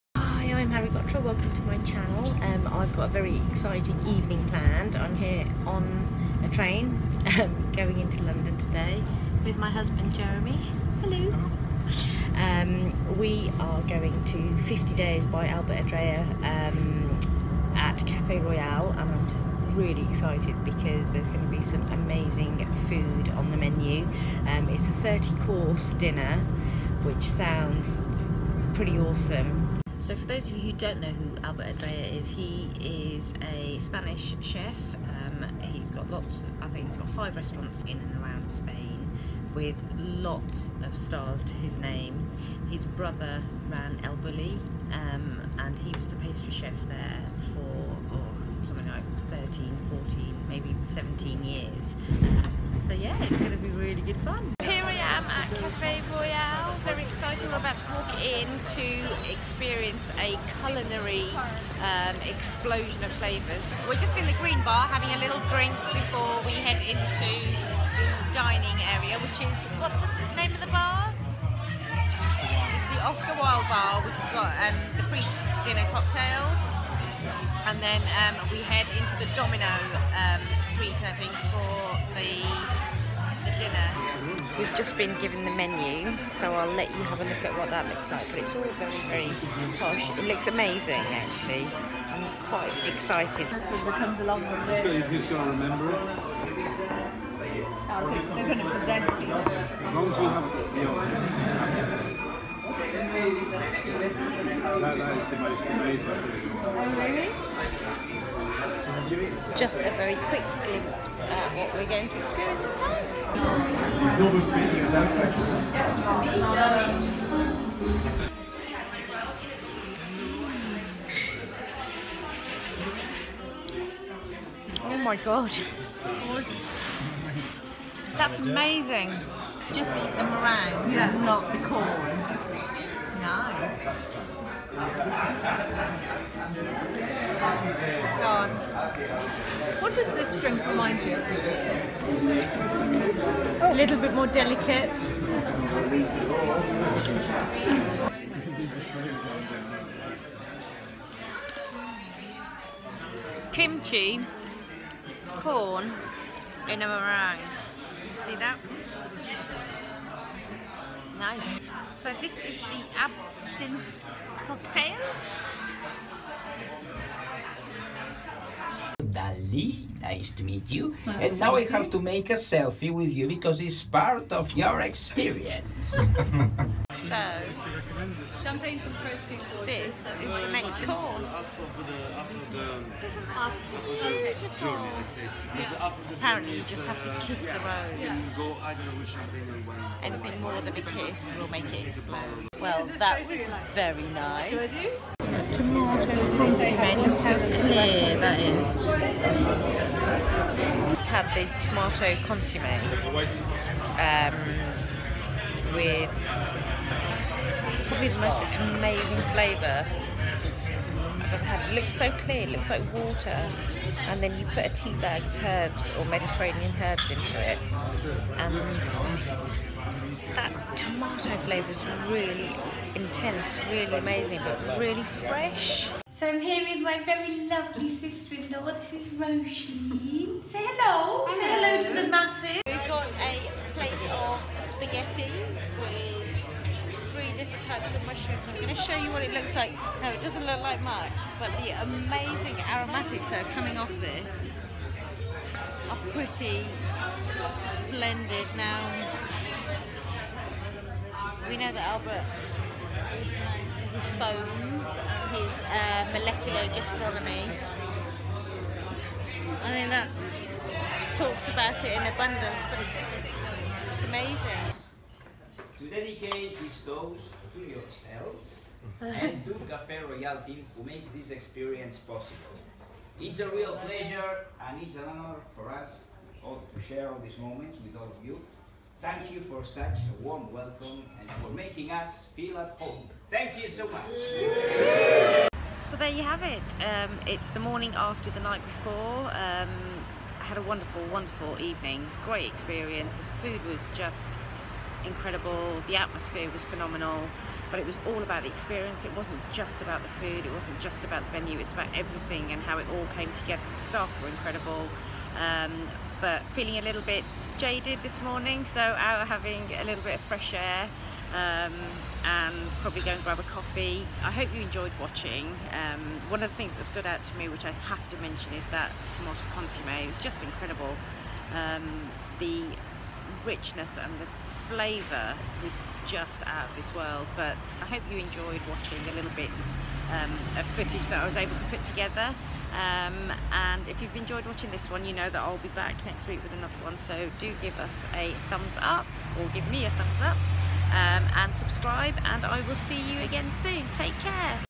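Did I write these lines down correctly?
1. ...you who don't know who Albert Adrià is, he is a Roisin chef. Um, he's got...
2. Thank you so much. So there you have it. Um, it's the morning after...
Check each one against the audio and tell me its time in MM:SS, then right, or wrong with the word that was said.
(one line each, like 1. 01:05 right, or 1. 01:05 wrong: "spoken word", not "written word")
1. 00:30 wrong: "Spanish", not "Roisin"
2. 04:43 right.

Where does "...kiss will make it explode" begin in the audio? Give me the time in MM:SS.
03:10.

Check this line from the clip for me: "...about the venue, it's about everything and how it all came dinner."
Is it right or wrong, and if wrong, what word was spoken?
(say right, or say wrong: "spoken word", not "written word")
wrong: "together", not "dinner".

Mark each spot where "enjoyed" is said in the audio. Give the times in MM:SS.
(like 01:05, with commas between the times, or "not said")
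05:14, 05:28, 05:34.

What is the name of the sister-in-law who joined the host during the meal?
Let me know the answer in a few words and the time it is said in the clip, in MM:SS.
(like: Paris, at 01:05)
Roisin, at 03:49.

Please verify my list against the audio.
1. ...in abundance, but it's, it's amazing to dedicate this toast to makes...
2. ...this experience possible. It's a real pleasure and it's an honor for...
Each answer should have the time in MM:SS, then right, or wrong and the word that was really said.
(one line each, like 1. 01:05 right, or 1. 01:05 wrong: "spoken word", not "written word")
1. 04:21 wrong: "yourselves", not "makes"
2. 04:31 right.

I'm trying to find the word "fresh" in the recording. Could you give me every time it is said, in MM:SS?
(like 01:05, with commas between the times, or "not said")
03:45, 05:10.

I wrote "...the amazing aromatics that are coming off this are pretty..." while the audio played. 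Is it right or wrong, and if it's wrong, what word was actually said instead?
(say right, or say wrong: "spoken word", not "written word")
right.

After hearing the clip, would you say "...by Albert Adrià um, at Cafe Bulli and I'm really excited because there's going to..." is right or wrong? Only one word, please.
wrong.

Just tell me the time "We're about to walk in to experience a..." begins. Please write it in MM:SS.
00:57.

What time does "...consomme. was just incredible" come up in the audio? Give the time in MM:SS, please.
05:19.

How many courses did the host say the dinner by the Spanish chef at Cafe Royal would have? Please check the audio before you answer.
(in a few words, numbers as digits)
30.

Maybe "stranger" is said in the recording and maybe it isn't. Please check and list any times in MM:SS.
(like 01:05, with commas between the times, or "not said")
not said.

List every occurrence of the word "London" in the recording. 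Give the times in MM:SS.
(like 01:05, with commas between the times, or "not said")
00:08.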